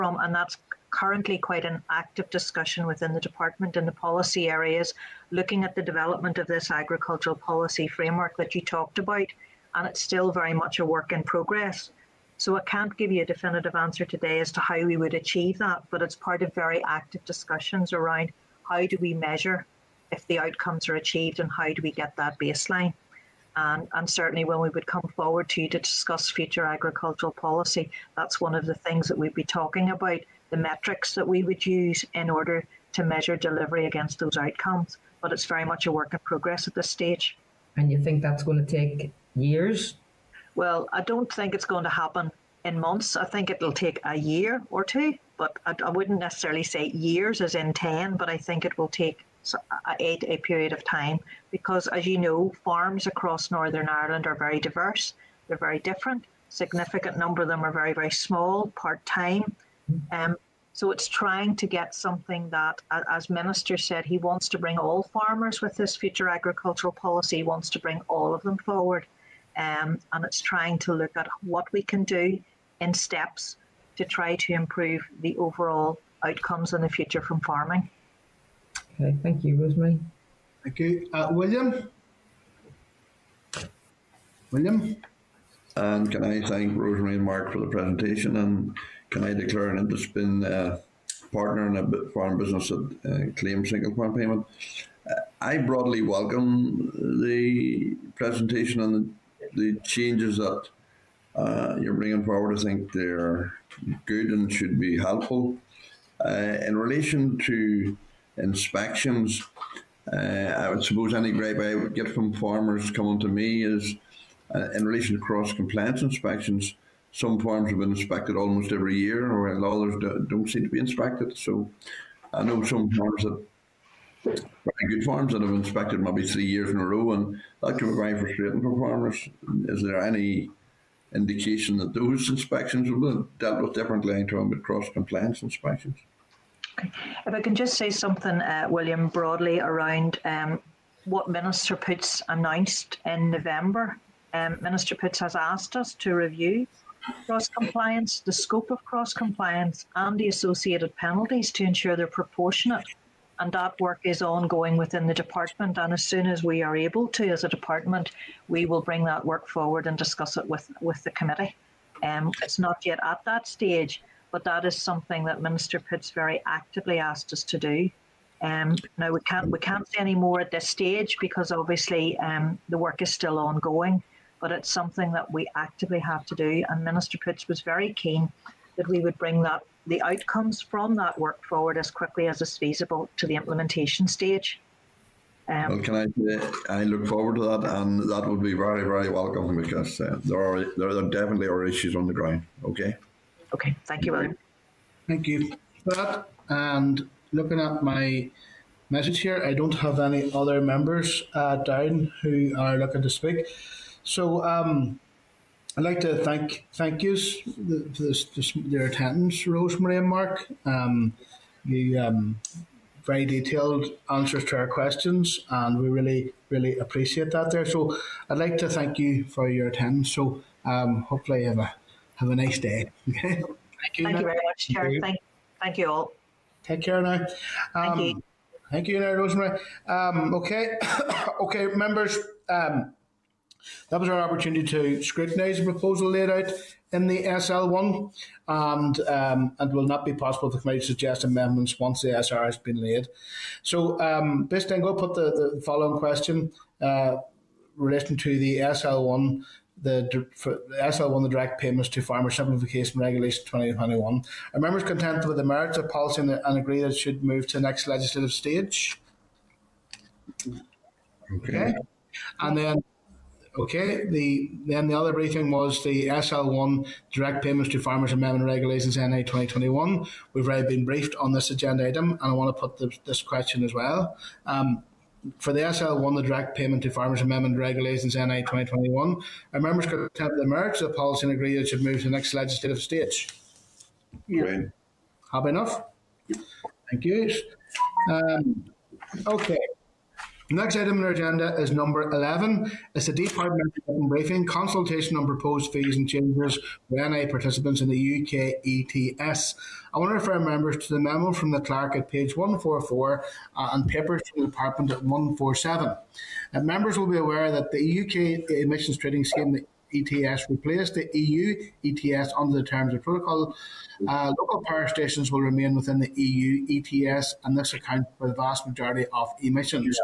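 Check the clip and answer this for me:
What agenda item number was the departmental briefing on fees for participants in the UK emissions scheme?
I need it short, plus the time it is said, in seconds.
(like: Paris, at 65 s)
11, at 291 s.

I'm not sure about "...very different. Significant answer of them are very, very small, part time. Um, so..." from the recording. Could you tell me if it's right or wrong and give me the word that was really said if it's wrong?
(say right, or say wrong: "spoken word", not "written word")
wrong: "number", not "answer".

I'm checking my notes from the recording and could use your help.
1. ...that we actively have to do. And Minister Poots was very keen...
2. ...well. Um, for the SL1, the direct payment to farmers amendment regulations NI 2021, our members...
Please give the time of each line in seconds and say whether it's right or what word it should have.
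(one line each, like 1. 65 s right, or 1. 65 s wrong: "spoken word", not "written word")
1. 175 s right
2. 273 s right.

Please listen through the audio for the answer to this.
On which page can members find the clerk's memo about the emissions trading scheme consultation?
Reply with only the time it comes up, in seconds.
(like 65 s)
302 s.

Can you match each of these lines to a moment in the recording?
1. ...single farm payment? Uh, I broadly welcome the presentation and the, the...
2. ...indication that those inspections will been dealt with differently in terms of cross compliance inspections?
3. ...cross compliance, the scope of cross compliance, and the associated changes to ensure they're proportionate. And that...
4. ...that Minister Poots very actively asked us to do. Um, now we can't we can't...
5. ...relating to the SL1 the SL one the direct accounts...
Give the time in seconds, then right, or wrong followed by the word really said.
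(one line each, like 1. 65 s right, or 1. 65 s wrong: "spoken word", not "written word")
1. 93 s right
2. 131 s right
3. 147 s wrong: "penalties", not "changes"
4. 165 s right
5. 247 s wrong: "payments", not "accounts".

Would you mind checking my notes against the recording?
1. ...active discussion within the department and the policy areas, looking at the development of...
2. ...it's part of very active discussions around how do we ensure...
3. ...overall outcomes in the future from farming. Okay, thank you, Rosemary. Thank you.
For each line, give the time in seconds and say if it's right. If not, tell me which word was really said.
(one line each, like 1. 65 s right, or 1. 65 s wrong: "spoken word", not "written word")
1. 1 s right
2. 16 s wrong: "measure", not "ensure"
3. 75 s right.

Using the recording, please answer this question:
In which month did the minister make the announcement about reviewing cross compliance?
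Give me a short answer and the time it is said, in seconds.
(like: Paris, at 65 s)
November, at 143 s.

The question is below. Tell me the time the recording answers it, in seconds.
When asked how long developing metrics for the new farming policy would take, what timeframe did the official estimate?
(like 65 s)
44 s.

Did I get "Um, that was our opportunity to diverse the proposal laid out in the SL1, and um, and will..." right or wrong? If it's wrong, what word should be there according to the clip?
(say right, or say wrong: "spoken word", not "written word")
wrong: "scrutinise", not "diverse".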